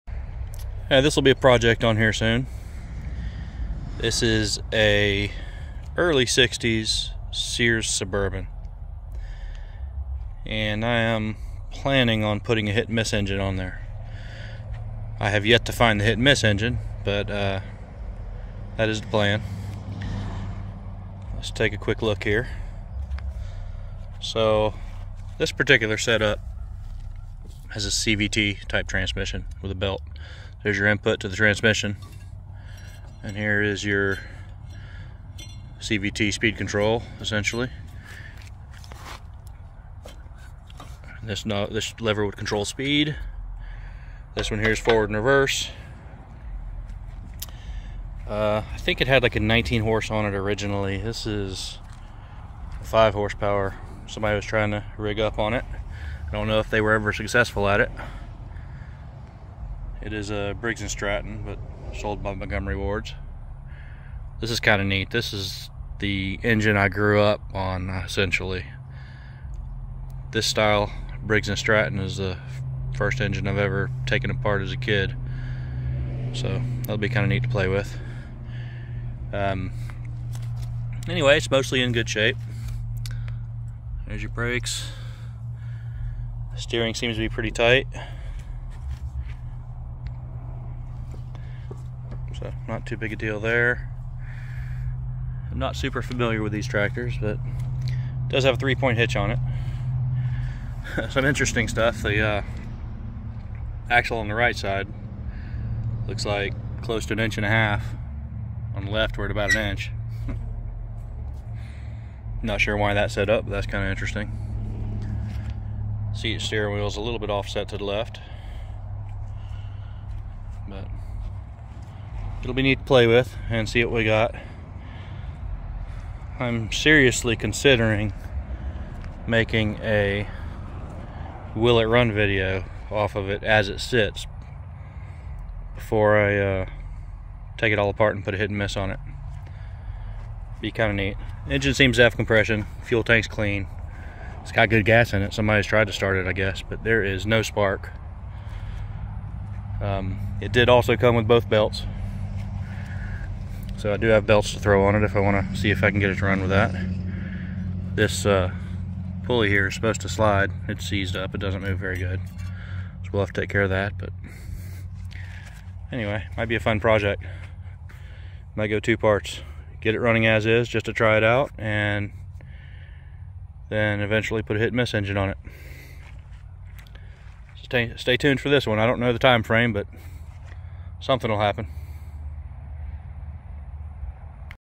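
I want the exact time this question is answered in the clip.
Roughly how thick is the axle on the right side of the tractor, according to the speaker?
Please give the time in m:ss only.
1:47.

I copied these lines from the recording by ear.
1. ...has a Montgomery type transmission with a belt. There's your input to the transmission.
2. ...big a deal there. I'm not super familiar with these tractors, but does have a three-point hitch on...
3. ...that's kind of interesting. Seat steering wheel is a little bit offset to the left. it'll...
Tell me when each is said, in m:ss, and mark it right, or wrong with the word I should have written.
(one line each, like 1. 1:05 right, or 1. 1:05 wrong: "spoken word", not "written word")
1. 0:27 wrong: "CVT", not "Montgomery"
2. 1:32 right
3. 1:53 right.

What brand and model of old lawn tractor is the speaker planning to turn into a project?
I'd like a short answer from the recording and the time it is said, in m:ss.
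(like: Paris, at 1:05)
Sears Suburban, at 0:07.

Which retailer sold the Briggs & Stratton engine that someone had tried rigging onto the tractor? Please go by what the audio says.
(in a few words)
Montgomery Wards.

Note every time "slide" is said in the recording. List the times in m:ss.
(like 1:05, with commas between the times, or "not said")
2:40.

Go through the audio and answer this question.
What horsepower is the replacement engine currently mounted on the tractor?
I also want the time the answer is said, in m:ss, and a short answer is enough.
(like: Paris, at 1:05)
5, at 0:52.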